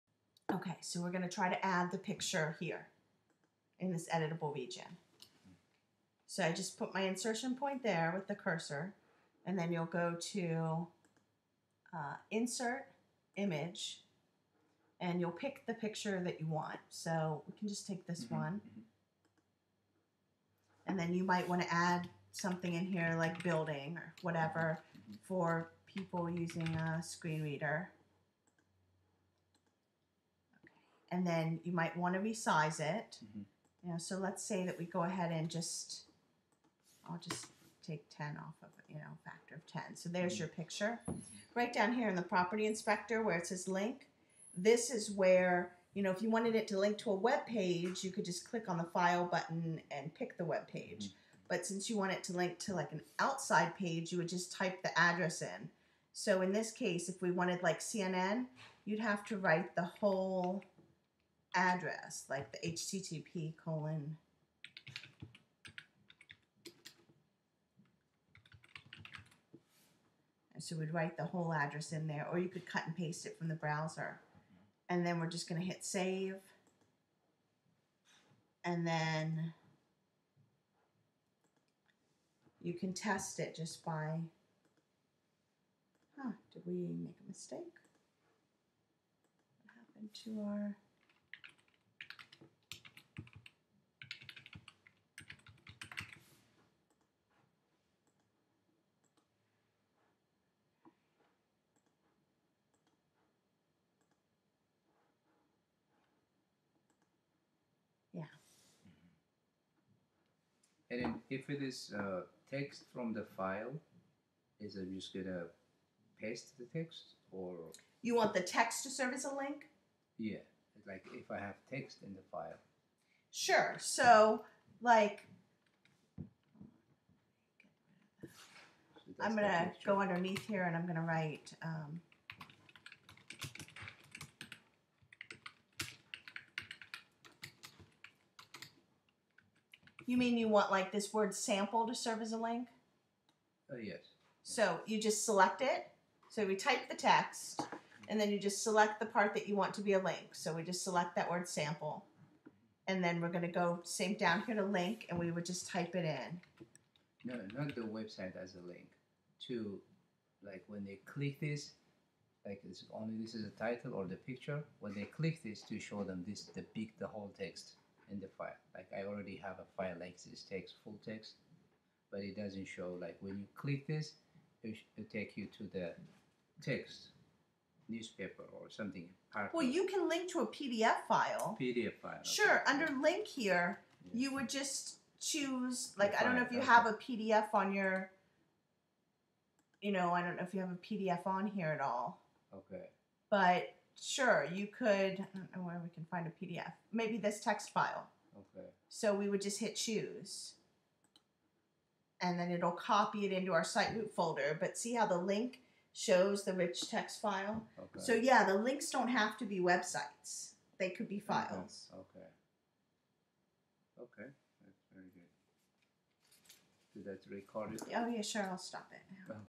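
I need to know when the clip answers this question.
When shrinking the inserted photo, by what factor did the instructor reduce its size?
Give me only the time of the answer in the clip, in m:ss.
0:39.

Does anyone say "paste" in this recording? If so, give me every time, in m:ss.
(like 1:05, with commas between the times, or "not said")
1:12, 1:56.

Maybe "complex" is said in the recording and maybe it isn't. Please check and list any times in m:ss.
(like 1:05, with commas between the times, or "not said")
not said.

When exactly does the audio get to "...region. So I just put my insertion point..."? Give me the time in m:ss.
0:04.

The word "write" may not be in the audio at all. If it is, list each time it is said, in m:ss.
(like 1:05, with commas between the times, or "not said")
0:59, 1:10, 2:11.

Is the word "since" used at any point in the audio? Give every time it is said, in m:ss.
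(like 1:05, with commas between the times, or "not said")
0:51.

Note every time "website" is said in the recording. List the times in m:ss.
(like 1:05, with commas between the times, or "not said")
2:37, 3:29.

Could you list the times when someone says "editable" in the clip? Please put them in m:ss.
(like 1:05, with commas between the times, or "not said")
0:04.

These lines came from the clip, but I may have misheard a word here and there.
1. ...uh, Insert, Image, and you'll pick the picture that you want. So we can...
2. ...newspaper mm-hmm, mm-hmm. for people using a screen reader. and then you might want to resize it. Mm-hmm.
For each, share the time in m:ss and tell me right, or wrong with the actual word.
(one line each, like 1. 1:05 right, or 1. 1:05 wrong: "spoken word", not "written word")
1. 0:11 right
2. 0:24 wrong: "whatever", not "newspaper".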